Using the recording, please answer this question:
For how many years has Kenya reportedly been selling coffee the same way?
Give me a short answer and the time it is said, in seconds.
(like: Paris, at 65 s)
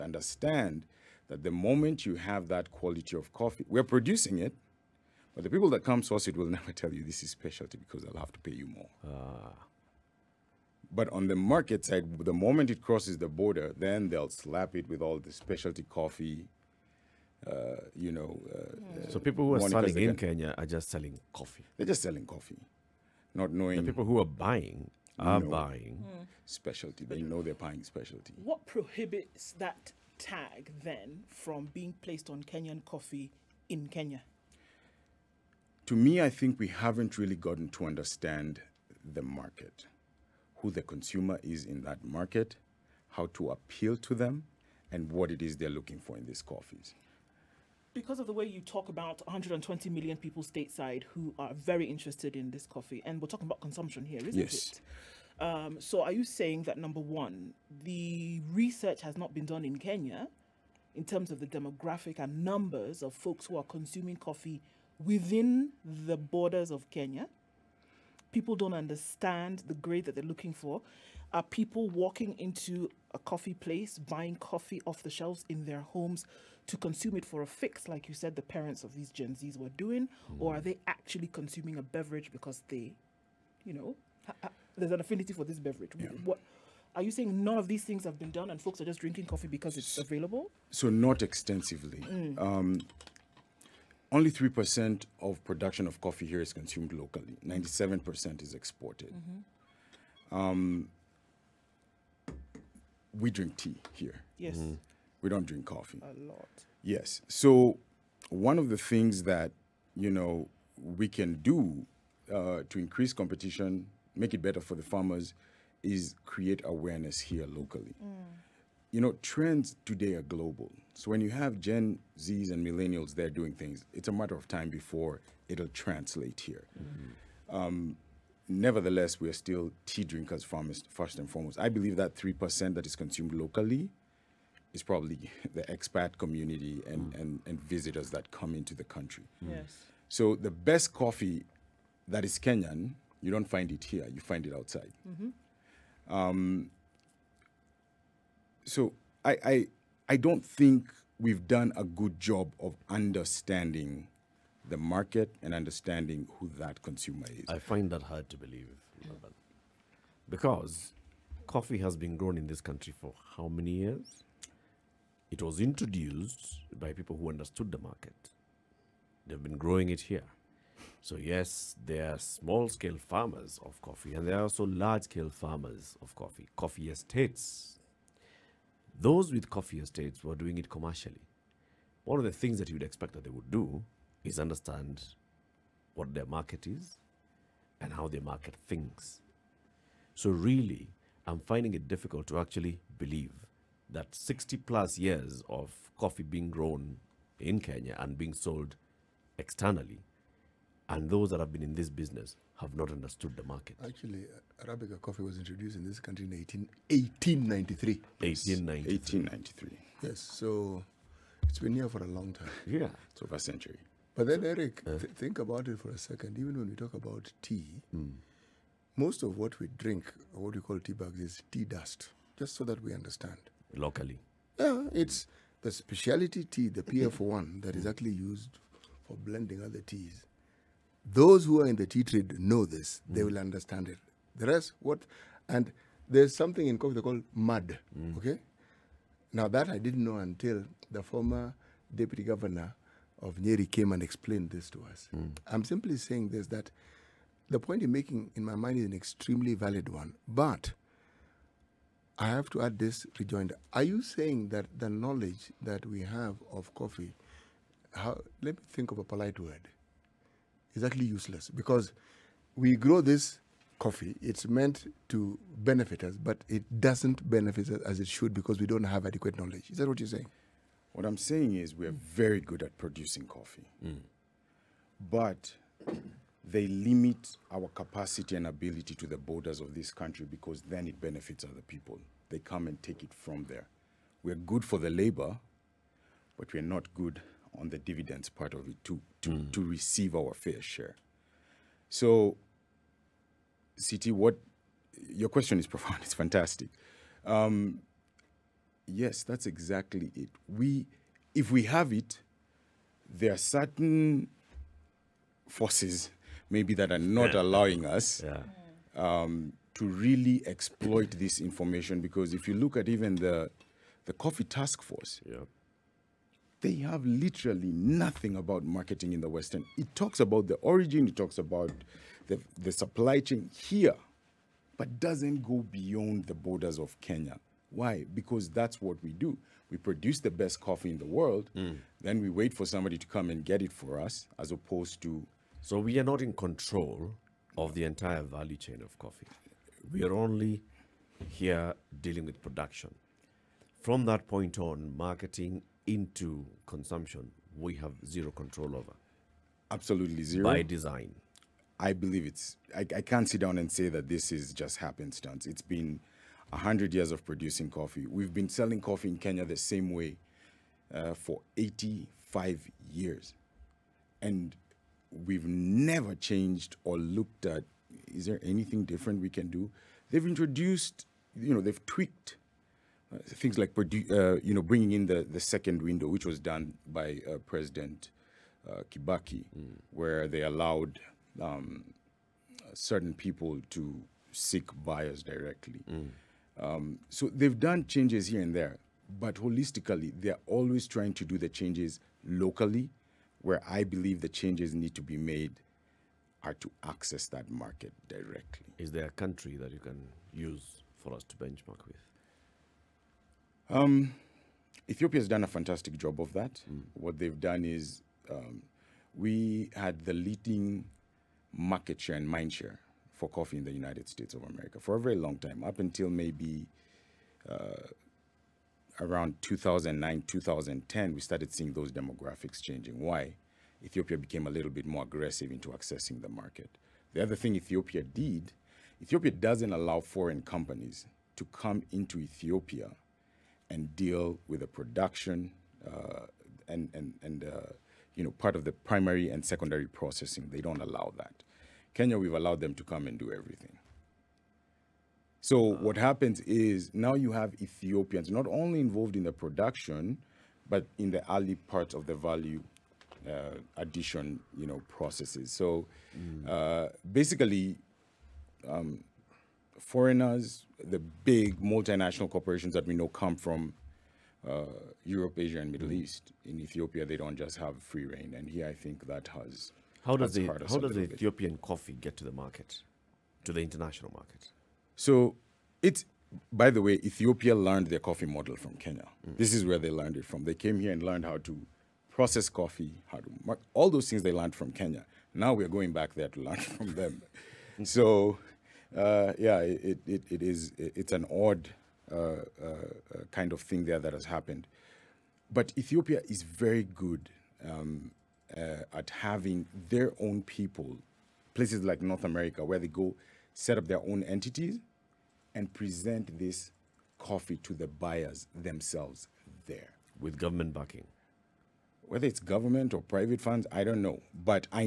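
85 years, at 361 s.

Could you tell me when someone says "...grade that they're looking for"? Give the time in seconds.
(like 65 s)
69 s.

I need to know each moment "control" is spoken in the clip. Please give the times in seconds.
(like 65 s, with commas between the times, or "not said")
336 s, 348 s.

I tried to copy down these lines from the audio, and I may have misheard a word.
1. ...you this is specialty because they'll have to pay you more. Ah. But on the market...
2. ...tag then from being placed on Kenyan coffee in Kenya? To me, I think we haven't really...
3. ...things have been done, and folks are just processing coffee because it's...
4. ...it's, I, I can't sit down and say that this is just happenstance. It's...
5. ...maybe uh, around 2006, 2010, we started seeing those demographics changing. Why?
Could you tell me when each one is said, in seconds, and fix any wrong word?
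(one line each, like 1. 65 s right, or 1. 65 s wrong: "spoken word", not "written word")
1. 6 s right
2. 30 s right
3. 87 s wrong: "drinking", not "processing"
4. 352 s right
5. 416 s wrong: "2009", not "2006".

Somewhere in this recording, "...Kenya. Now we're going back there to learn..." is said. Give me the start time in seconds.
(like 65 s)
484 s.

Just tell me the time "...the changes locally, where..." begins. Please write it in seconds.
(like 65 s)
391 s.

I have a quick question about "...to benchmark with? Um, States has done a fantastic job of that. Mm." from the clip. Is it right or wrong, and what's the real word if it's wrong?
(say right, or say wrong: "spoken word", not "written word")
wrong: "Ethiopia", not "States".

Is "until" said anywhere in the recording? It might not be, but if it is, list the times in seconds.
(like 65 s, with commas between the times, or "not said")
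240 s, 415 s.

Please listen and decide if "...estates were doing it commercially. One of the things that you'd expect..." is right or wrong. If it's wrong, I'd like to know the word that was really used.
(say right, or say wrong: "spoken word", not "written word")
right.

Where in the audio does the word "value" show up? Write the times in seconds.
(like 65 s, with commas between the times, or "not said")
338 s, 452 s.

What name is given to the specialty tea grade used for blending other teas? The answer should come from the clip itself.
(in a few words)
PF1.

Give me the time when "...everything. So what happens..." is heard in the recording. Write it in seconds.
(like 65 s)
443 s.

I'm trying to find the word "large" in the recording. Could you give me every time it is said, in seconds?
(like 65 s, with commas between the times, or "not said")
174 s.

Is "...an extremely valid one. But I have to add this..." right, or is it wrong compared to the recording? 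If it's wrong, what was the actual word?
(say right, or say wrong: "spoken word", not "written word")
right.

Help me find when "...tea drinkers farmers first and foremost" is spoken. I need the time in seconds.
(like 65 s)
129 s.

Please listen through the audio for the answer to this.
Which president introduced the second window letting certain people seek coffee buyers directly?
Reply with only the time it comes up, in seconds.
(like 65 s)
378 s.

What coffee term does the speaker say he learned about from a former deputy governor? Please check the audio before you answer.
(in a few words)
mud.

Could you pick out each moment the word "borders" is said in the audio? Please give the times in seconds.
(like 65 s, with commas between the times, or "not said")
13 s, 66 s, 279 s, 326 s.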